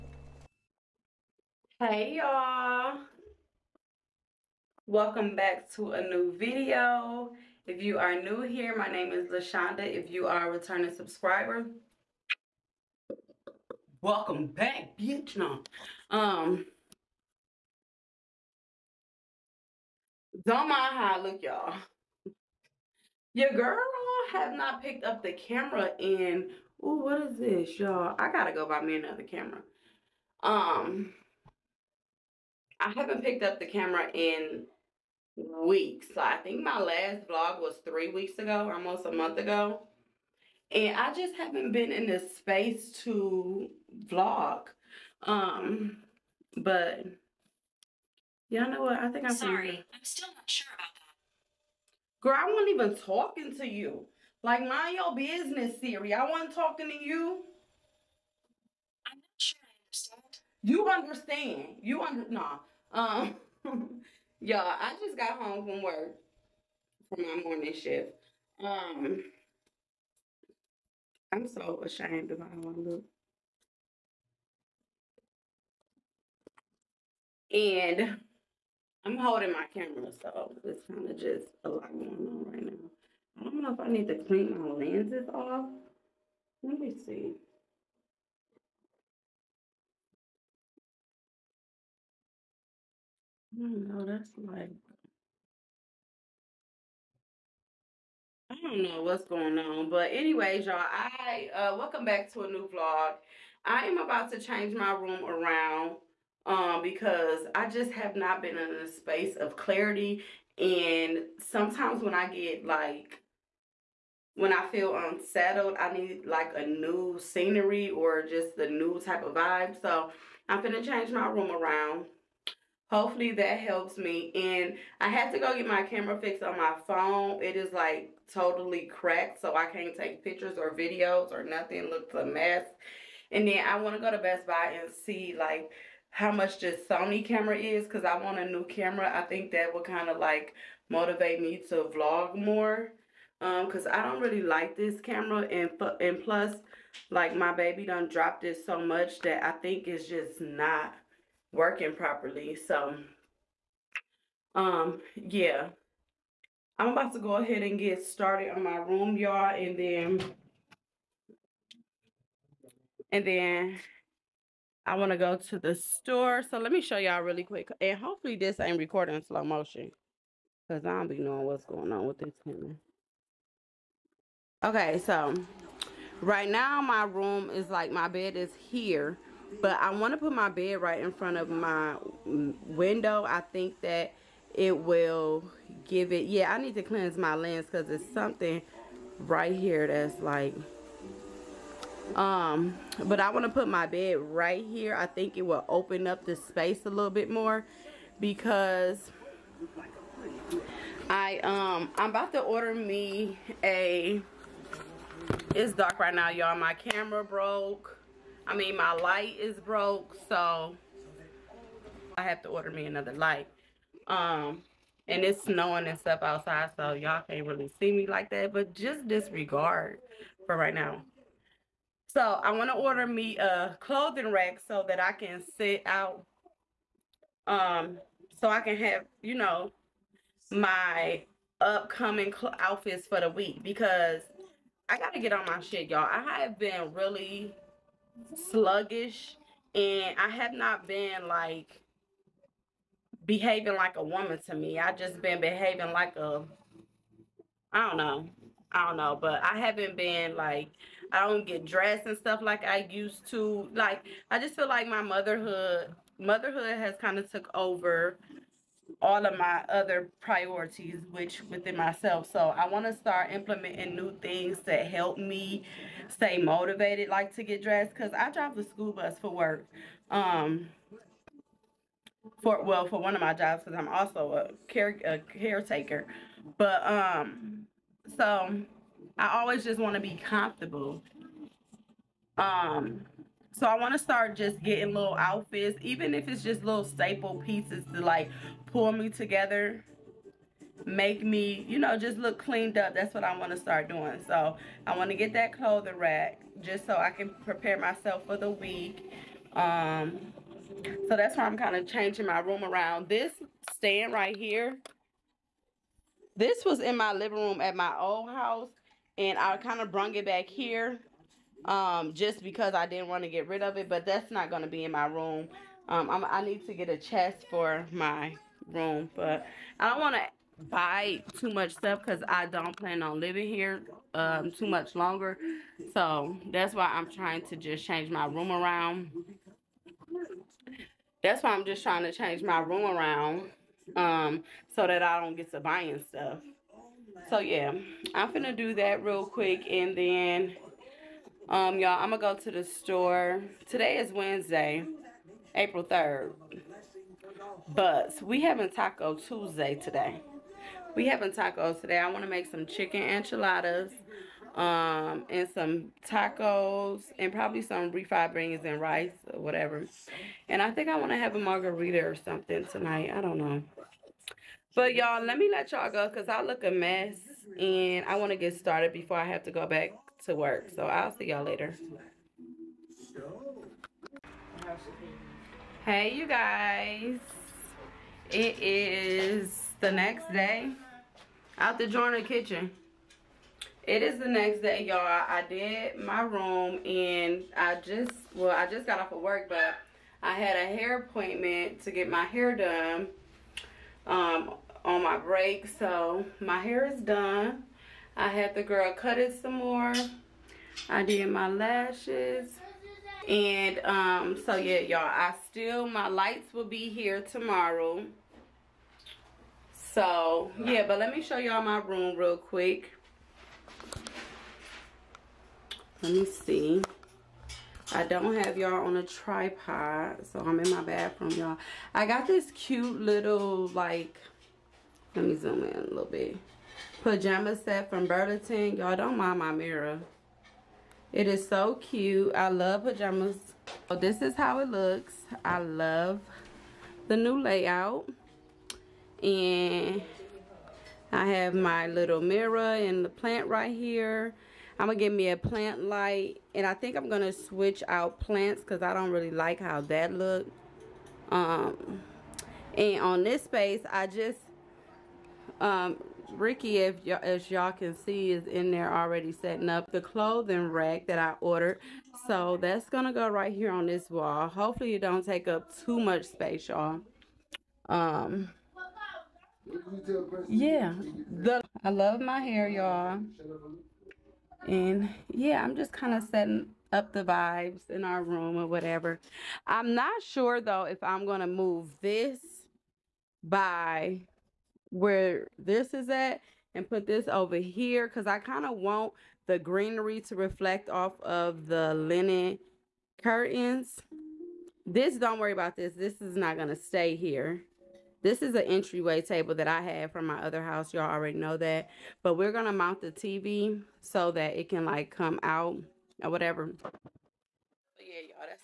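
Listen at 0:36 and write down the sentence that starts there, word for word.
so I think my last vlog was three weeks ago, almost a month ago.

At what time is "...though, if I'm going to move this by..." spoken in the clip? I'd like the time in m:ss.
8:00.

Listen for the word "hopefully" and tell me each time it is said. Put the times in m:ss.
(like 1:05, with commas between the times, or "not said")
2:02, 2:47, 7:44.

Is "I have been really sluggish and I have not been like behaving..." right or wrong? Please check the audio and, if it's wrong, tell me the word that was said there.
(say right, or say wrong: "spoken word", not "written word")
right.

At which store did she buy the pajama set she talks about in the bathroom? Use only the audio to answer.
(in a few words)
Burlington.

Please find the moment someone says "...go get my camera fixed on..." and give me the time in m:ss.
2:05.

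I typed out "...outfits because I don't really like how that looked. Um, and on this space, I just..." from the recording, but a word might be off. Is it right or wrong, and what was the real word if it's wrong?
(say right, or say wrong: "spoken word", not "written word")
wrong: "plants", not "outfits".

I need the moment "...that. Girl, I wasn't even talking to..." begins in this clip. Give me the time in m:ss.
0:50.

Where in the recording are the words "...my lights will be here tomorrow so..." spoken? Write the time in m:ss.
6:45.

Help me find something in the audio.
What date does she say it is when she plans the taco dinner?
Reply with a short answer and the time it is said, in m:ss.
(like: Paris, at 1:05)
Wednesday, April 3rd, at 5:44.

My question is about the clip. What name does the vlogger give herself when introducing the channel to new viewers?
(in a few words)
Lashawnda.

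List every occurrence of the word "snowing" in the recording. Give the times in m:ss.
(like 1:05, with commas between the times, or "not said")
3:35.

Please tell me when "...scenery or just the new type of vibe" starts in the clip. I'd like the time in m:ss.
1:57.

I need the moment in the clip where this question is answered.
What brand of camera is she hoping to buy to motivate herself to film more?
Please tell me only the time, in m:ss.
2:16.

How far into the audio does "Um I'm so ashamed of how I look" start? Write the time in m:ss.
1:08.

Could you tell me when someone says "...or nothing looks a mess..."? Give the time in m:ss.
2:11.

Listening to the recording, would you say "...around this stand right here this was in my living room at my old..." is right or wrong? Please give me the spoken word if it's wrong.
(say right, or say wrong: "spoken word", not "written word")
right.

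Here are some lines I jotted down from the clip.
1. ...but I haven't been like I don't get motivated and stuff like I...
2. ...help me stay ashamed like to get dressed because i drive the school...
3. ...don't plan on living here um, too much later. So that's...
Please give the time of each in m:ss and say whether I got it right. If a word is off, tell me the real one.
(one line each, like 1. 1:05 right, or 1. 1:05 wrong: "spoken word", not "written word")
1. 4:09 wrong: "dressed", not "motivated"
2. 4:24 wrong: "motivated", not "ashamed"
3. 5:22 wrong: "longer", not "later".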